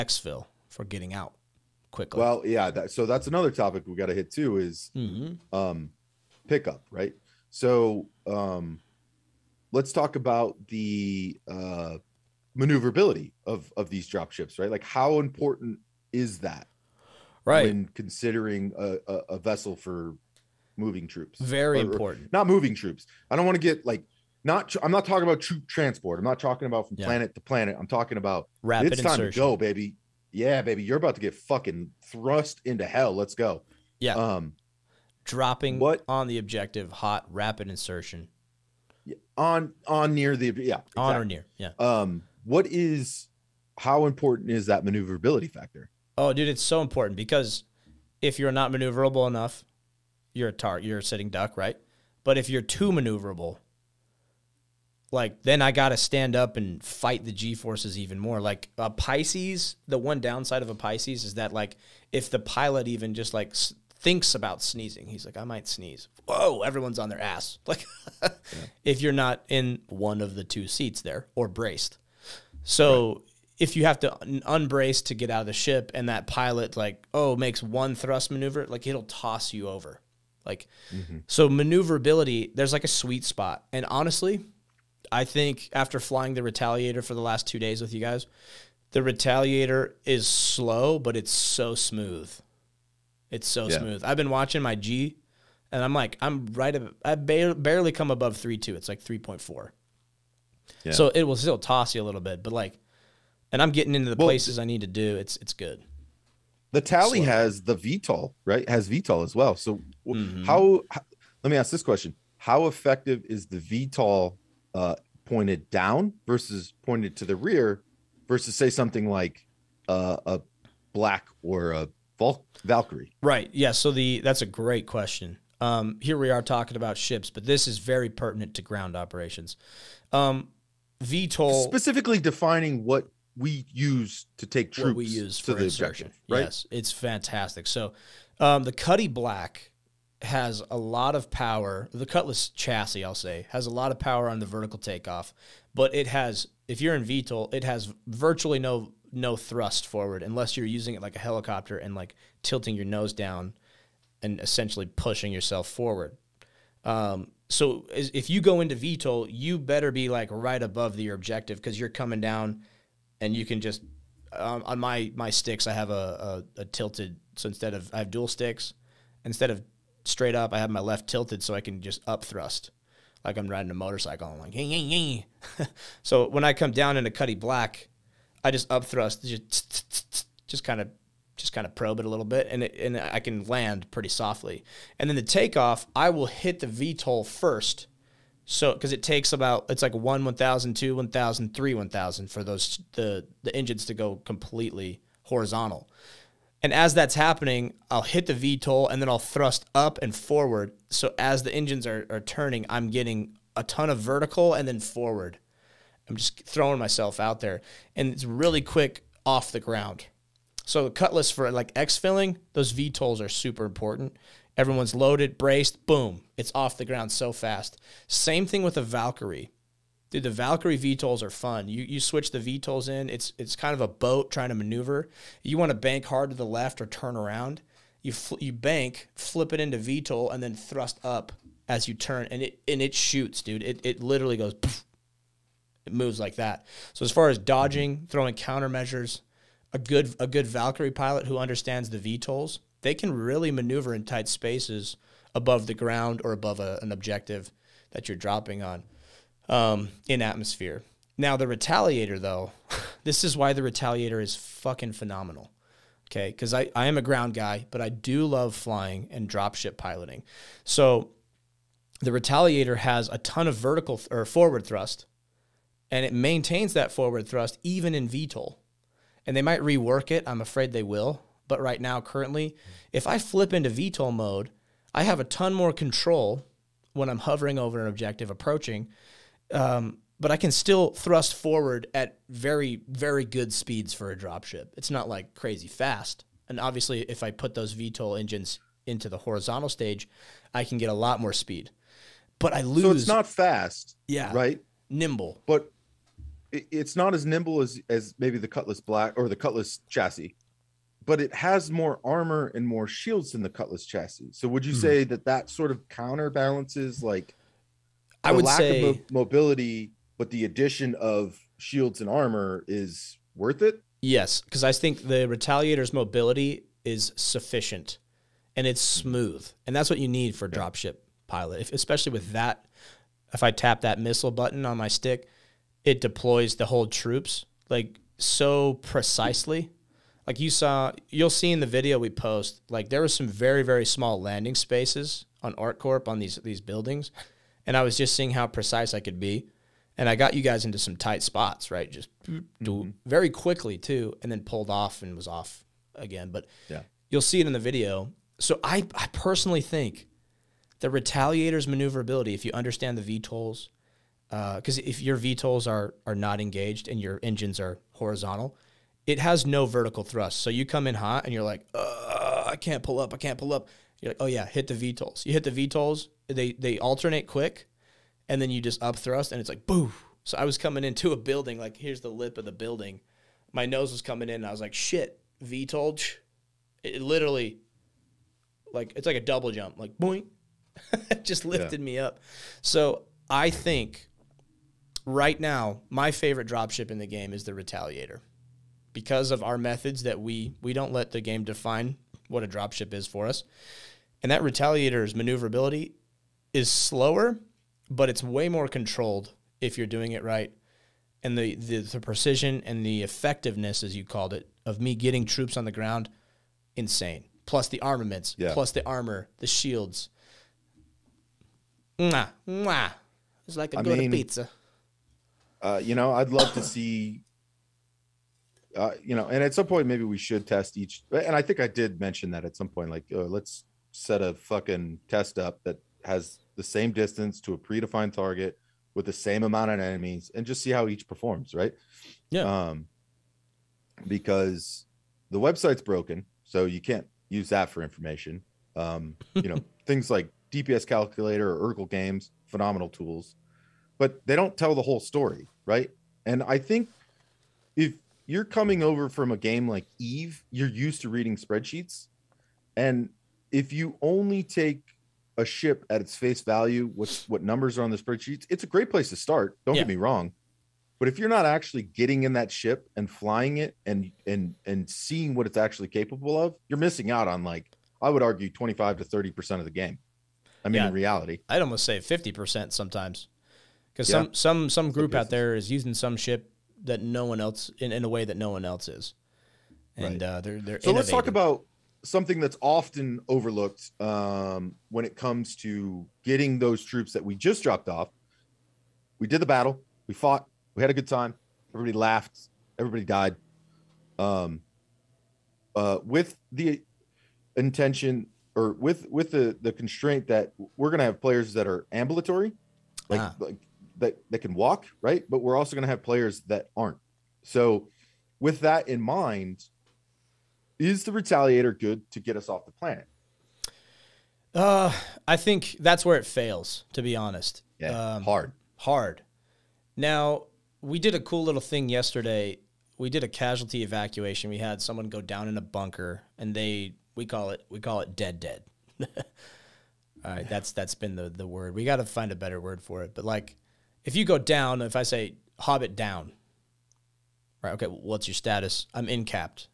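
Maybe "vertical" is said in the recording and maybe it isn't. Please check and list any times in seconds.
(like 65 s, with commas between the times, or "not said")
144 s, 203 s, 263 s, 359 s.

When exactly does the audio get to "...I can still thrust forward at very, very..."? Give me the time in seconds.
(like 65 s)
280 s.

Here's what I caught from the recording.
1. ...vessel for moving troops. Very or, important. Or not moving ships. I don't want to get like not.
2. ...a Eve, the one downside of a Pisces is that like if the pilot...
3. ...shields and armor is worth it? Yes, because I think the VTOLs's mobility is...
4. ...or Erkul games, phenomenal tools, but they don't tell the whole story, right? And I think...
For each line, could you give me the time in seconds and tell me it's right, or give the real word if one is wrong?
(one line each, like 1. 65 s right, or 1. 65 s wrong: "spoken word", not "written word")
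1. 19 s wrong: "troops", not "ships"
2. 58 s wrong: "Pisces", not "Eve"
3. 311 s wrong: "Retaliator", not "VTOLs"
4. 441 s right.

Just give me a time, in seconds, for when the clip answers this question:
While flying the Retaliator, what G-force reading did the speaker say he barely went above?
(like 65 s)
99 s.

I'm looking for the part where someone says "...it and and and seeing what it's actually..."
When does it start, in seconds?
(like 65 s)
463 s.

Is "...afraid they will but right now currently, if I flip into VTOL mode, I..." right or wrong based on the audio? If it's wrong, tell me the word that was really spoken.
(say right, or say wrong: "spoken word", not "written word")
right.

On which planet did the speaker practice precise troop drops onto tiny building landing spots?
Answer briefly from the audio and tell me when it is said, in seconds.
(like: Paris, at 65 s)
ArcCorp, at 335 s.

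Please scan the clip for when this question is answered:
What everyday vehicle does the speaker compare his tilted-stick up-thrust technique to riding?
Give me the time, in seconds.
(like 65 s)
173 s.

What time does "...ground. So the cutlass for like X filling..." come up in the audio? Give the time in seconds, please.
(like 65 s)
209 s.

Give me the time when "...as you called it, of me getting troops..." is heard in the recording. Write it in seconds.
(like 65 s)
403 s.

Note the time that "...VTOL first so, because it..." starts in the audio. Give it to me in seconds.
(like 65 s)
186 s.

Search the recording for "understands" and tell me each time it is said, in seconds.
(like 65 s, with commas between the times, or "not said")
241 s, 352 s.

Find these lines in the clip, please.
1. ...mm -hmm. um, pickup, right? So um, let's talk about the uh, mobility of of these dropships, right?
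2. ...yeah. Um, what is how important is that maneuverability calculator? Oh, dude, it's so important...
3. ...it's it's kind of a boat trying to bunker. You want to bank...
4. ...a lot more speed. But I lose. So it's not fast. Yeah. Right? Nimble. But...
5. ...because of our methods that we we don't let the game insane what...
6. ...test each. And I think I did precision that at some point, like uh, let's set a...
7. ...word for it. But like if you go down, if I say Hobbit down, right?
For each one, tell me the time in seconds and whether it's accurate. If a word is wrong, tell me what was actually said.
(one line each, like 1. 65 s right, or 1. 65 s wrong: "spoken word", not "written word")
1. 4 s wrong: "maneuverability", not "mobility"
2. 41 s wrong: "factor", not "calculator"
3. 223 s wrong: "maneuver", not "bunker"
4. 290 s right
5. 388 s wrong: "define", not "insane"
6. 420 s wrong: "mention", not "precision"
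7. 532 s right.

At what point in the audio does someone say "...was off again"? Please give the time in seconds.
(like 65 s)
345 s.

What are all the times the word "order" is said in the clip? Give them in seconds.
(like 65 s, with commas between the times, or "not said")
not said.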